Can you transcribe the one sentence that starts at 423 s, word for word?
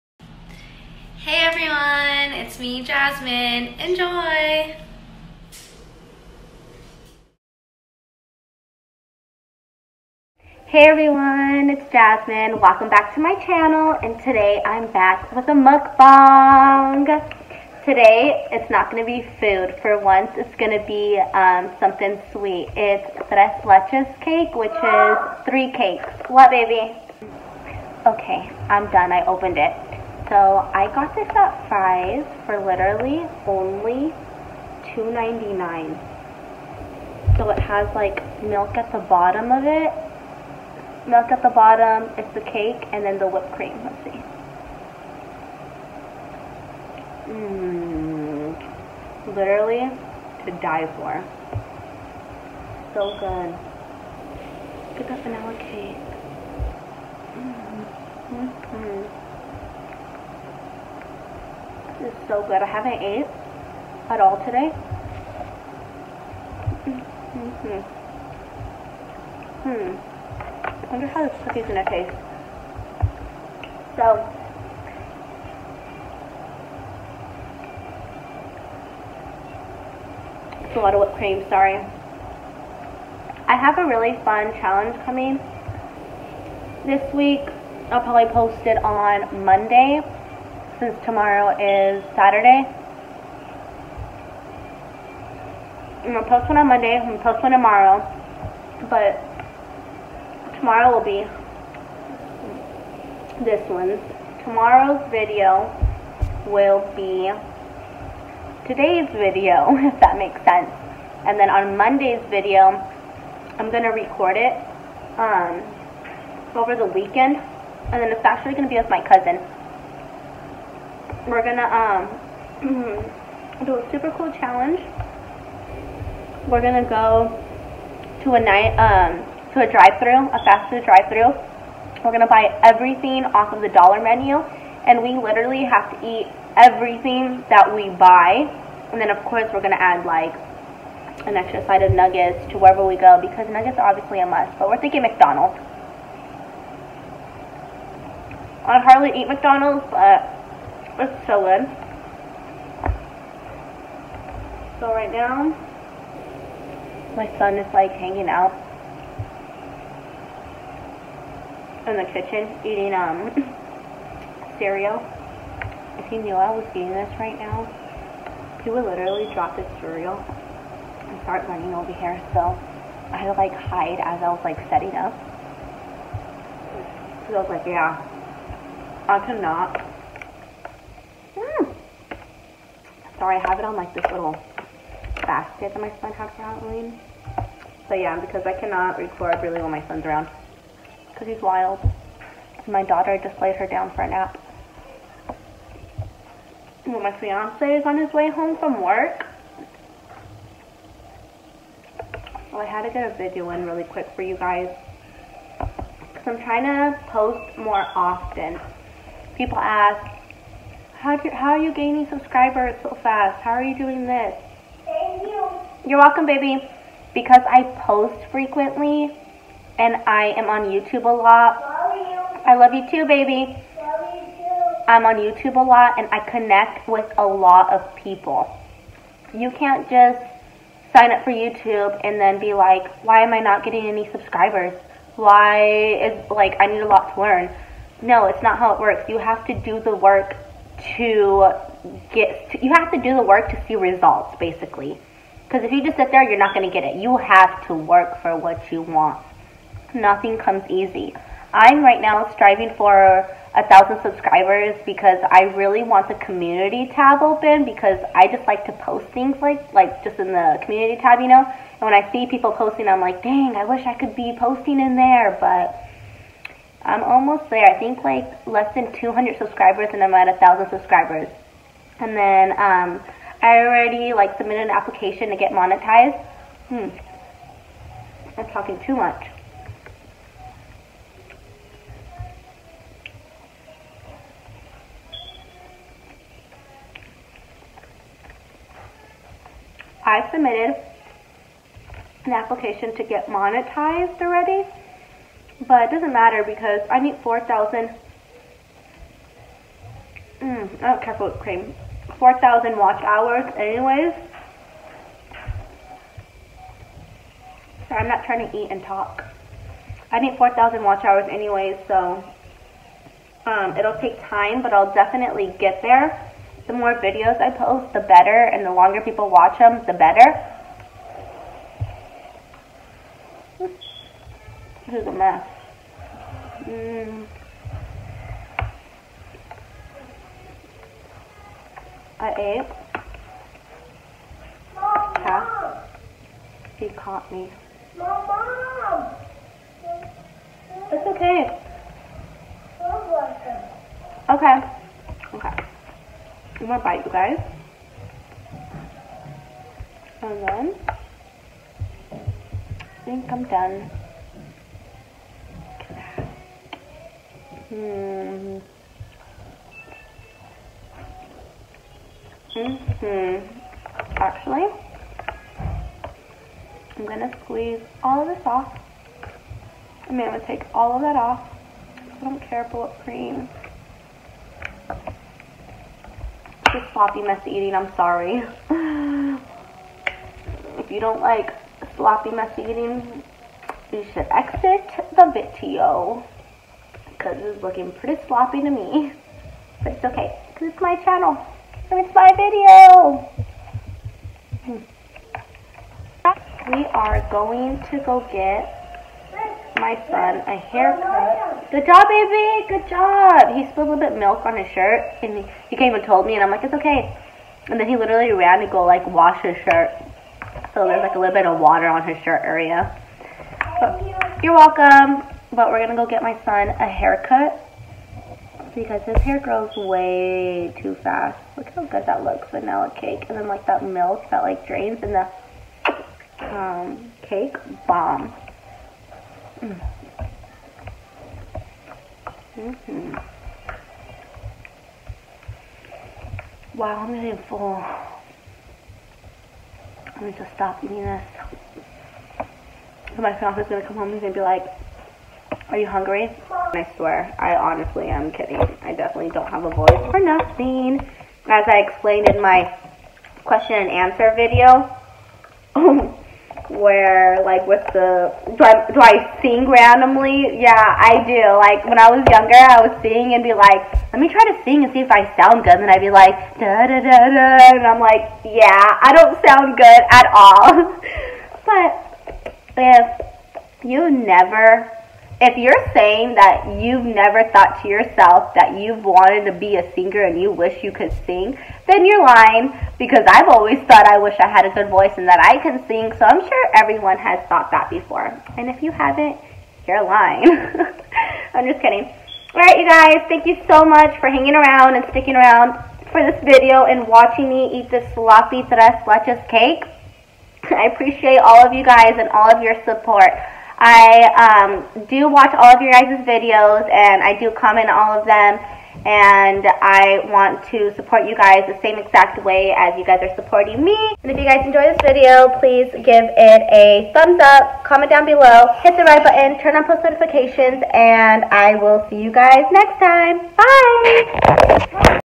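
And then like that milk that like drains and the um, cake, bomb.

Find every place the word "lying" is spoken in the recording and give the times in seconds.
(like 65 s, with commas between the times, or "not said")
482 s, 490 s.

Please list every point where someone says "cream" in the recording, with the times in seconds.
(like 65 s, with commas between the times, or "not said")
43 s, 81 s, 301 s, 373 s.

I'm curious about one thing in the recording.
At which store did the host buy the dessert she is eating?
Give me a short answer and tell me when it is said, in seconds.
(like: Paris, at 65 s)
Fry's, at 31 s.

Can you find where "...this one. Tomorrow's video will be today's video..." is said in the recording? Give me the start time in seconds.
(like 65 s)
103 s.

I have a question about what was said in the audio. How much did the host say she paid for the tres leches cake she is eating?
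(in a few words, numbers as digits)
$2.99.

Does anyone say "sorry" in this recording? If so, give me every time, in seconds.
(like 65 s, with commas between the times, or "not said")
81 s, 183 s, 377 s.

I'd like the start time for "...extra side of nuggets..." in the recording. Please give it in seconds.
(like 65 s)
141 s.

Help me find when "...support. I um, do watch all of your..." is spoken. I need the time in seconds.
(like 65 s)
502 s.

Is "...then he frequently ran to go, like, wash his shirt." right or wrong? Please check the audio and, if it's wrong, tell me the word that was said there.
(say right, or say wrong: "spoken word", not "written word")
wrong: "literally", not "frequently".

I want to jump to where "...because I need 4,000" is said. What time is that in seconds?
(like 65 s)
296 s.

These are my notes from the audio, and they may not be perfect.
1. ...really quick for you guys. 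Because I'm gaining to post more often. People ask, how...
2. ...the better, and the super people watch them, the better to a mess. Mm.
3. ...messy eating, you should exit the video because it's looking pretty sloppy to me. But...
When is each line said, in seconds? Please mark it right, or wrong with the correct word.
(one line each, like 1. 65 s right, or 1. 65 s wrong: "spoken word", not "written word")
1. 203 s wrong: "trying", not "gaining"
2. 317 s wrong: "longer", not "super"
3. 382 s right.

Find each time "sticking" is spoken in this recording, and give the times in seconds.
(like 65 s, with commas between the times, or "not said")
495 s.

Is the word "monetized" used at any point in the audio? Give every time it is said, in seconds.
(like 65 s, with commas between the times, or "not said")
275 s, 293 s.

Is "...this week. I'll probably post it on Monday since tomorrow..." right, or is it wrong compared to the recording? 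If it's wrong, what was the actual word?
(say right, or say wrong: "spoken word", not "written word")
right.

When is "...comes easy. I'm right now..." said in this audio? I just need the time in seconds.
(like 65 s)
250 s.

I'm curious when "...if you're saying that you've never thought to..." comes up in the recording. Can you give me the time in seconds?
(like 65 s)
475 s.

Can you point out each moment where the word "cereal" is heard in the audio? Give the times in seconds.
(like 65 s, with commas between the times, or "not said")
164 s, 169 s.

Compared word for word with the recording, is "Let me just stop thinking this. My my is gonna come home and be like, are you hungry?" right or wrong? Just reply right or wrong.
wrong.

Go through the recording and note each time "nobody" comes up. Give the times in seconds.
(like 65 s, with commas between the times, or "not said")
not said.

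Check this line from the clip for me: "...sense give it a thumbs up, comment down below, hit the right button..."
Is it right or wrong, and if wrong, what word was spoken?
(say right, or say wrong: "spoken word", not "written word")
wrong: "please", not "sense".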